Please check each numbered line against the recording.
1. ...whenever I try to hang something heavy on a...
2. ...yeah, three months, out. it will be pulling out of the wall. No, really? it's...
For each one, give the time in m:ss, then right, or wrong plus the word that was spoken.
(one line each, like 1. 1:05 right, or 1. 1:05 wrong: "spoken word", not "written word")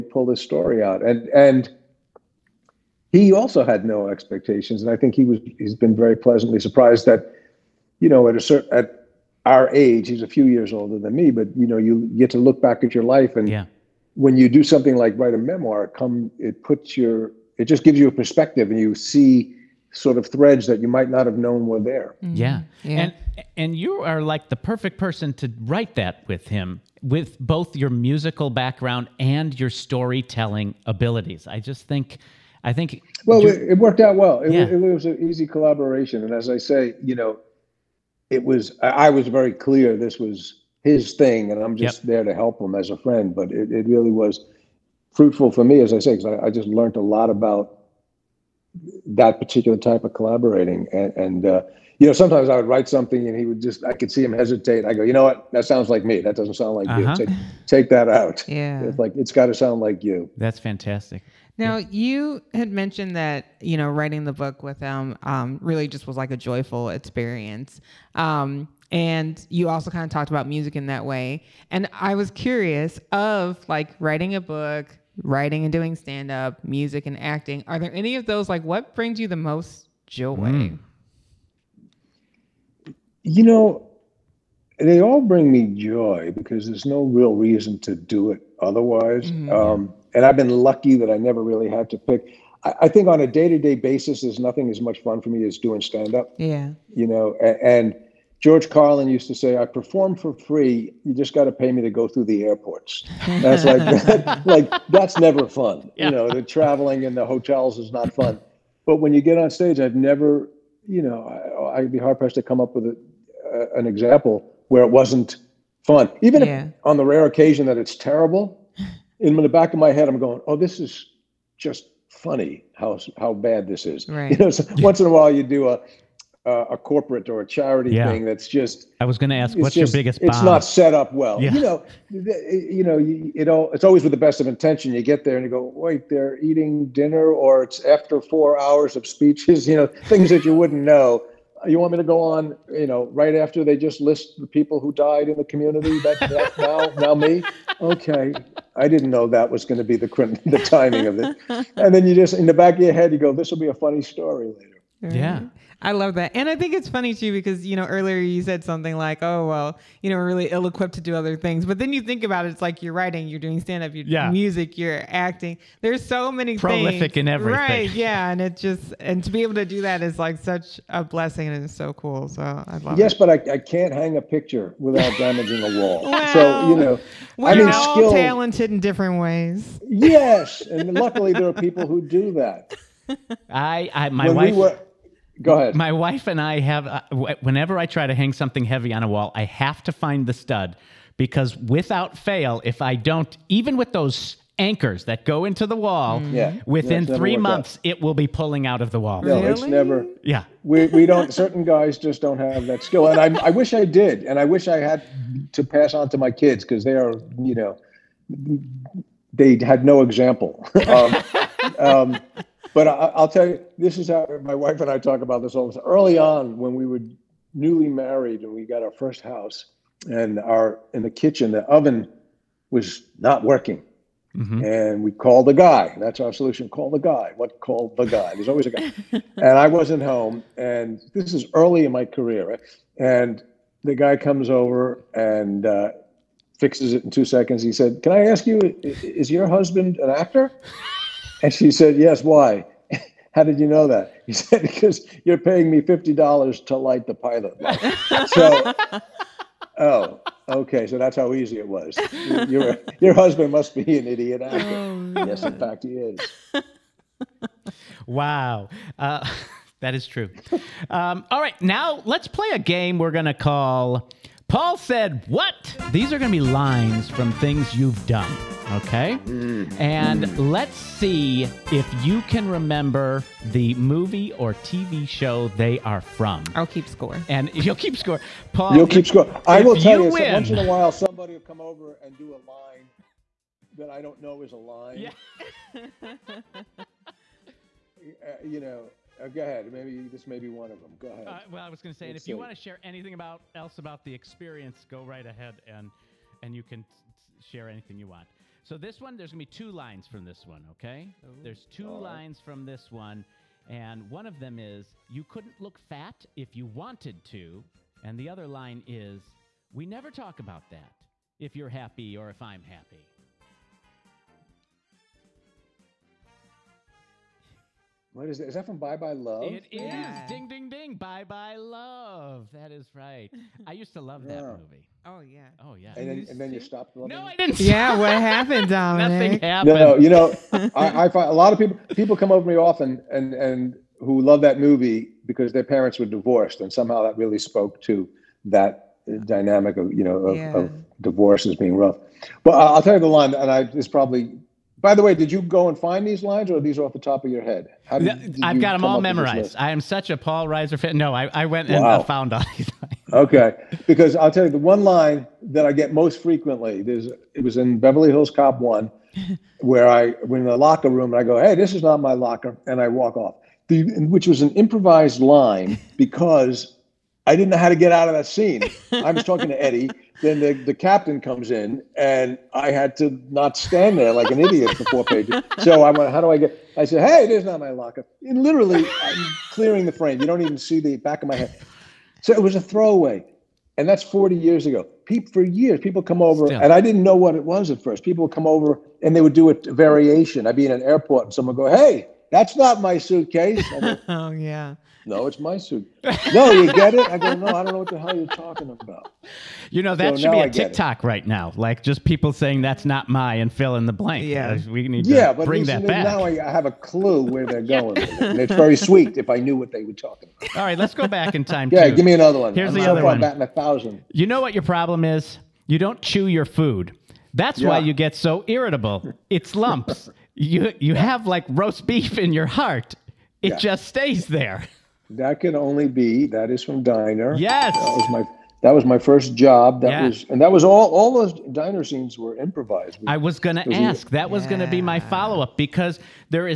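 1. 3:07 right
2. 3:17 right.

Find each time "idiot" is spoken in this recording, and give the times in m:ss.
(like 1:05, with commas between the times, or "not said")
4:14, 6:14.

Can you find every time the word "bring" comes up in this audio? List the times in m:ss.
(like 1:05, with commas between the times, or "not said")
1:18, 1:25, 6:45.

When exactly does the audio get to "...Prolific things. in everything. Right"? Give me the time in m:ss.
2:46.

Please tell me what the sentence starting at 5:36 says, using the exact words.
And somehow that really spoke to that dynamic of, you know, of, yeah.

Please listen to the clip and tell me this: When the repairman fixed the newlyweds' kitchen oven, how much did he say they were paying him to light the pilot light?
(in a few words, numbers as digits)
$50.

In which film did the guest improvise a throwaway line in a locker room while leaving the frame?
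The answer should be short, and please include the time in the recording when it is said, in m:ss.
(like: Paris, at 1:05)
Beverly Hills Cop, at 5:57.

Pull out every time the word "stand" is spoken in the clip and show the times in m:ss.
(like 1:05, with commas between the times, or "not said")
1:15, 1:35, 2:43, 6:13.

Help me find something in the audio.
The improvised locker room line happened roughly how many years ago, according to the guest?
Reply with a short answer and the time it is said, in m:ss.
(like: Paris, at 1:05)
40, at 6:24.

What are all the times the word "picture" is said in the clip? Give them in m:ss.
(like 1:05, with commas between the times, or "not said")
2:54.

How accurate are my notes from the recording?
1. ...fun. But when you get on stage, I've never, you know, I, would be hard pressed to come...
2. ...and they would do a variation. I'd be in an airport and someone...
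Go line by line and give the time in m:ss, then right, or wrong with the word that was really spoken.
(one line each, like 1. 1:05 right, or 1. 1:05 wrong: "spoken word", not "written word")
1. 1:48 right
2. 6:29 right.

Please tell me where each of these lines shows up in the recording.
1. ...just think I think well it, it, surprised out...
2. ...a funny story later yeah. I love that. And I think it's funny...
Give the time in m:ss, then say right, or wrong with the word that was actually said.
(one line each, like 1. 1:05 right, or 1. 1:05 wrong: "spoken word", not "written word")
1. 0:31 wrong: "worked", not "surprised"
2. 2:33 right.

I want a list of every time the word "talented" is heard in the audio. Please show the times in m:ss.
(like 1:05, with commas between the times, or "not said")
2:58.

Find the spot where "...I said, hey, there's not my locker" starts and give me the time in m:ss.
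6:16.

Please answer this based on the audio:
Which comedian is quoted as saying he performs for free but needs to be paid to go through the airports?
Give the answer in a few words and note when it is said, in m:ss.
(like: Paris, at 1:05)
George Carlin, at 1:38.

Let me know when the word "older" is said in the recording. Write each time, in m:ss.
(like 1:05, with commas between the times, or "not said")
0:10.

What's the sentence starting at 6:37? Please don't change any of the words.
I go, no, I don't know what the hell you're talking about.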